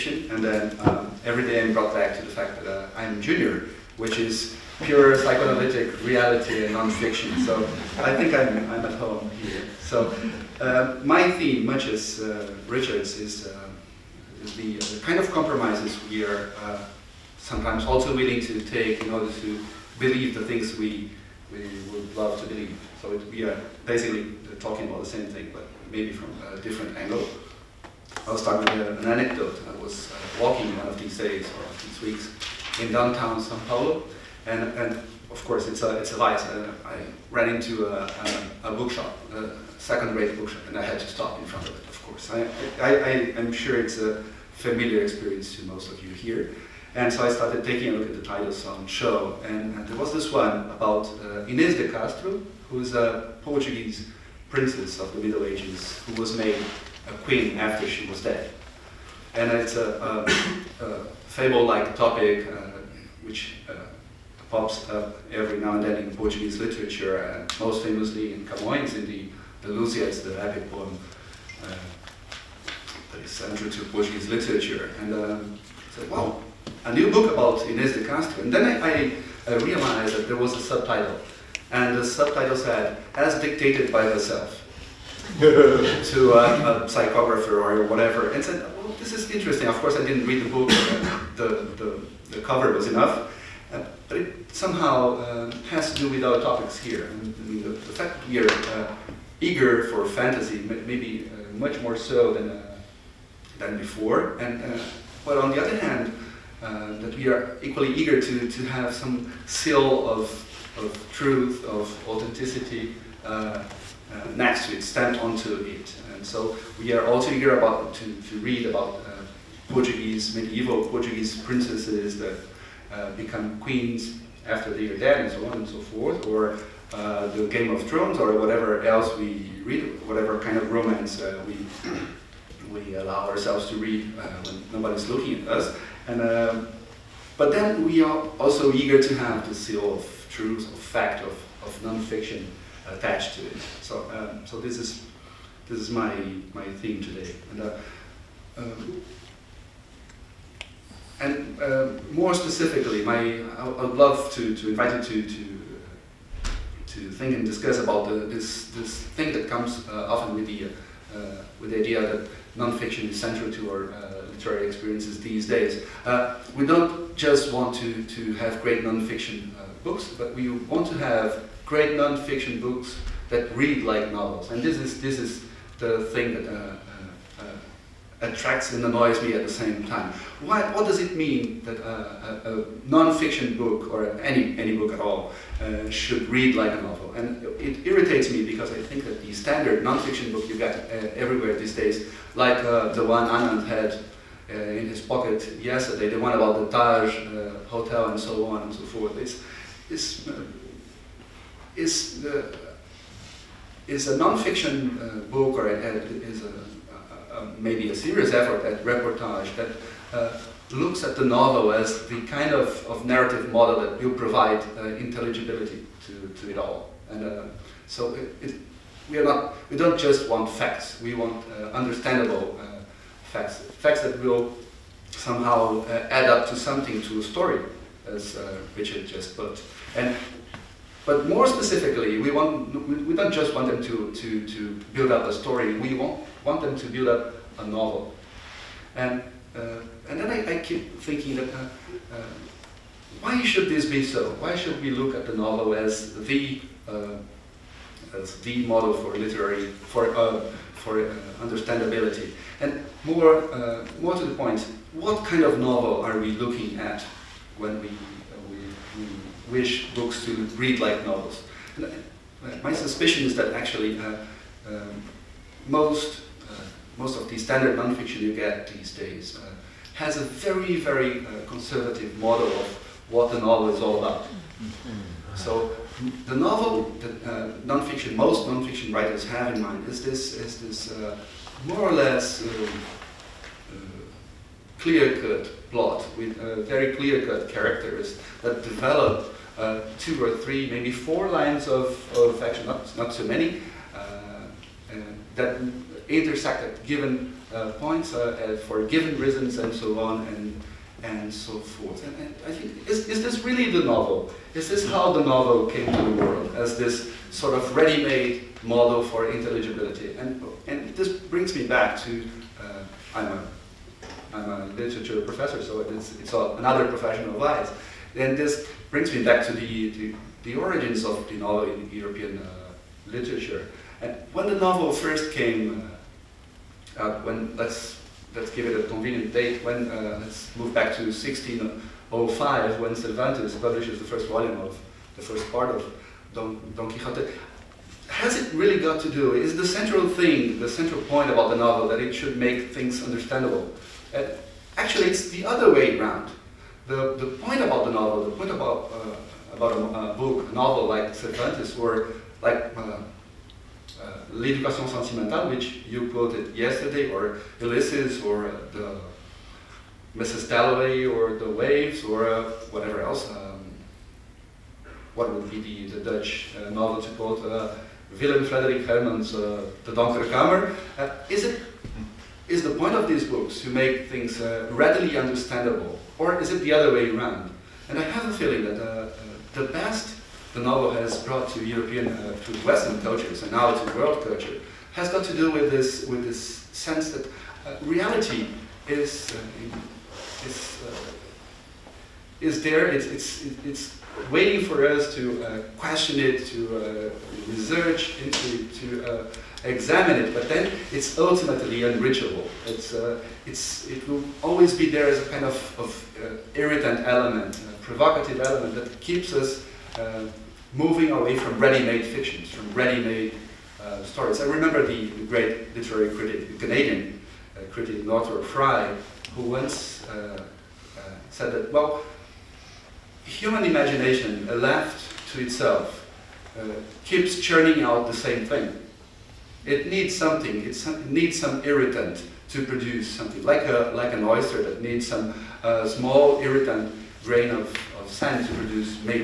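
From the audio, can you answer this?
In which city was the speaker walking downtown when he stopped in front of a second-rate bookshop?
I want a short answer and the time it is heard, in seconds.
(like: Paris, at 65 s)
Sao Paulo, at 33 s.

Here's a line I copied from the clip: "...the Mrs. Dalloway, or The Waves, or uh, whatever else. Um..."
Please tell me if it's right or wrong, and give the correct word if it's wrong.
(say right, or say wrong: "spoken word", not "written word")
right.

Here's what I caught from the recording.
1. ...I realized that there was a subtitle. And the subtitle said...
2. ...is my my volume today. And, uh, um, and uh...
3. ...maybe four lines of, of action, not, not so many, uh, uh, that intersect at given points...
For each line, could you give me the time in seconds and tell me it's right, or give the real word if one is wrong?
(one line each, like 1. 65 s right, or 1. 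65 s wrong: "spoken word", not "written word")
1. 79 s right
2. 145 s wrong: "theme", not "volume"
3. 290 s right.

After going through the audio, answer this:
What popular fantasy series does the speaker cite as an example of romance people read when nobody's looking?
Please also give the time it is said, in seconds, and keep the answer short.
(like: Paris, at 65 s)
Game of Thrones, at 127 s.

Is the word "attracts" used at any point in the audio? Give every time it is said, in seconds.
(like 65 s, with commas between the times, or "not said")
178 s.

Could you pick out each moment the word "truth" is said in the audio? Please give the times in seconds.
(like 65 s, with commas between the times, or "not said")
111 s, 140 s.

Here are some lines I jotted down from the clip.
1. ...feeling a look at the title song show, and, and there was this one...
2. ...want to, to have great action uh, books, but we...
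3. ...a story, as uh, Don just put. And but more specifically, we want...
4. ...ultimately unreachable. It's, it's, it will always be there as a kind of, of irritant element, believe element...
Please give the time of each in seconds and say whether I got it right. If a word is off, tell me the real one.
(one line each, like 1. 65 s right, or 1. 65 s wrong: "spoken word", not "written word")
1. 47 s wrong: "taking", not "feeling"
2. 167 s wrong: "nonfiction", not "action"
3. 227 s wrong: "Richard", not "Don"
4. 401 s wrong: "provocative", not "believe".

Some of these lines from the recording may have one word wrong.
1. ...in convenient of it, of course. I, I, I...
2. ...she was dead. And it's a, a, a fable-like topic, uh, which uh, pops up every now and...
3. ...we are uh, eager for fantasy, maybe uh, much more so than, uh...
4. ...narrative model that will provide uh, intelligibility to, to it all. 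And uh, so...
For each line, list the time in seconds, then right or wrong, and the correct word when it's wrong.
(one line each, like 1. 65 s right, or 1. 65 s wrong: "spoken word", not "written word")
1. 41 s wrong: "front", not "convenient"
2. 57 s right
3. 98 s right
4. 213 s right.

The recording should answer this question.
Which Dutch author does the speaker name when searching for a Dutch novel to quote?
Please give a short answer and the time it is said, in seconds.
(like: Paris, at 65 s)
Willem Frederik Hermans, at 368 s.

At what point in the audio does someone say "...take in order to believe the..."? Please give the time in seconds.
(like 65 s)
18 s.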